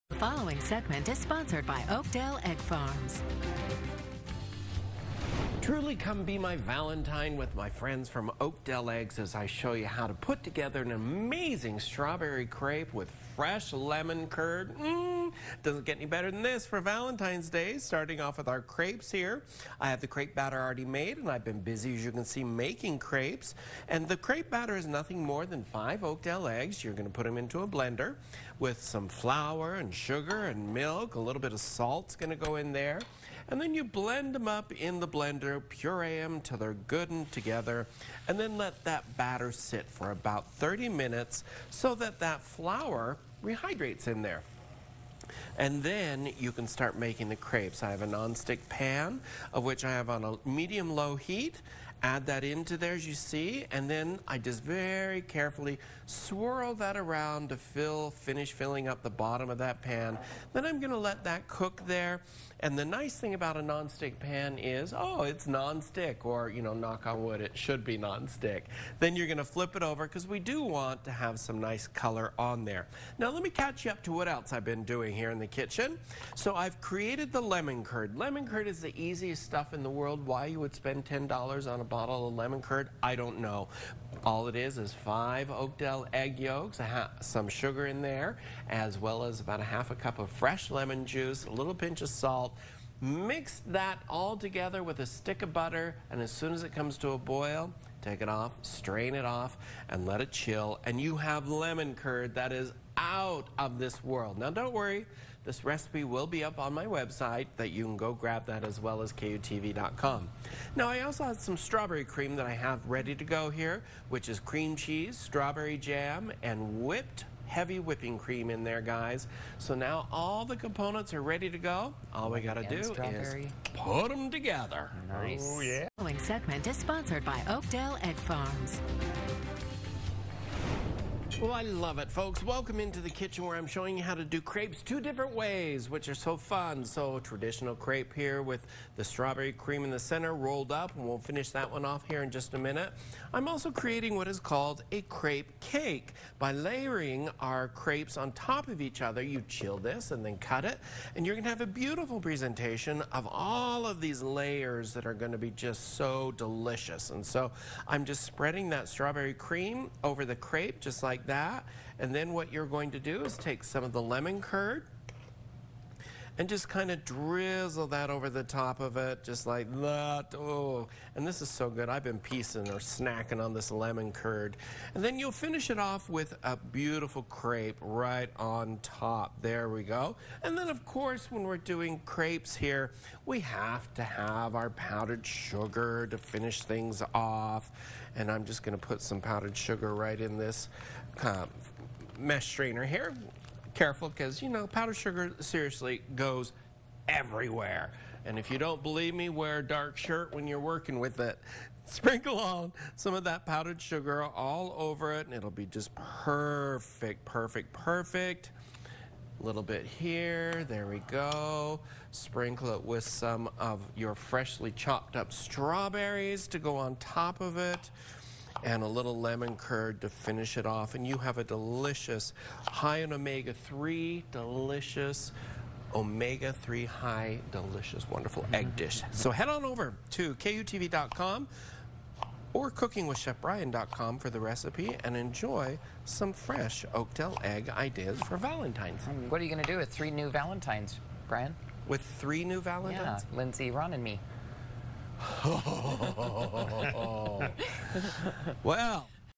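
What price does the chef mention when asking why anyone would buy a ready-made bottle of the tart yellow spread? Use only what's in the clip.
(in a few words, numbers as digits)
$10.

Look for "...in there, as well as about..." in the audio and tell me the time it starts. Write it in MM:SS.
01:27.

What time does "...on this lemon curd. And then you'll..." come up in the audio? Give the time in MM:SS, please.
02:53.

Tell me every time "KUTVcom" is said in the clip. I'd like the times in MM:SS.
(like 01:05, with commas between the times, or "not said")
01:49, 03:50.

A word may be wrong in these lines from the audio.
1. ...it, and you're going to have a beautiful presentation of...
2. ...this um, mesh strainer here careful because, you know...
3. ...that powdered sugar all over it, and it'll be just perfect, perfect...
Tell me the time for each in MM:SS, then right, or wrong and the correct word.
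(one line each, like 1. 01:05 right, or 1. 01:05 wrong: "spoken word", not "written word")
1. 02:30 right
2. 03:10 right
3. 03:23 right.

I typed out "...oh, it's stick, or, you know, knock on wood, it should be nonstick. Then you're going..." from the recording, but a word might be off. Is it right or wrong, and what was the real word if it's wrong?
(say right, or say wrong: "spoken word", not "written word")
wrong: "nonstick", not "stick".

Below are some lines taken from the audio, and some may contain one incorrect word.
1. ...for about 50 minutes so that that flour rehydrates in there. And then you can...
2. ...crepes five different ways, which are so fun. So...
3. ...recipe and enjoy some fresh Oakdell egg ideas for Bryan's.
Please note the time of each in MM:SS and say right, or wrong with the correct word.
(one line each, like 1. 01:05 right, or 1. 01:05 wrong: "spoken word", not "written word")
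1. 00:39 wrong: "30", not "50"
2. 02:14 wrong: "two", not "five"
3. 03:54 wrong: "Valentine", not "Bryan".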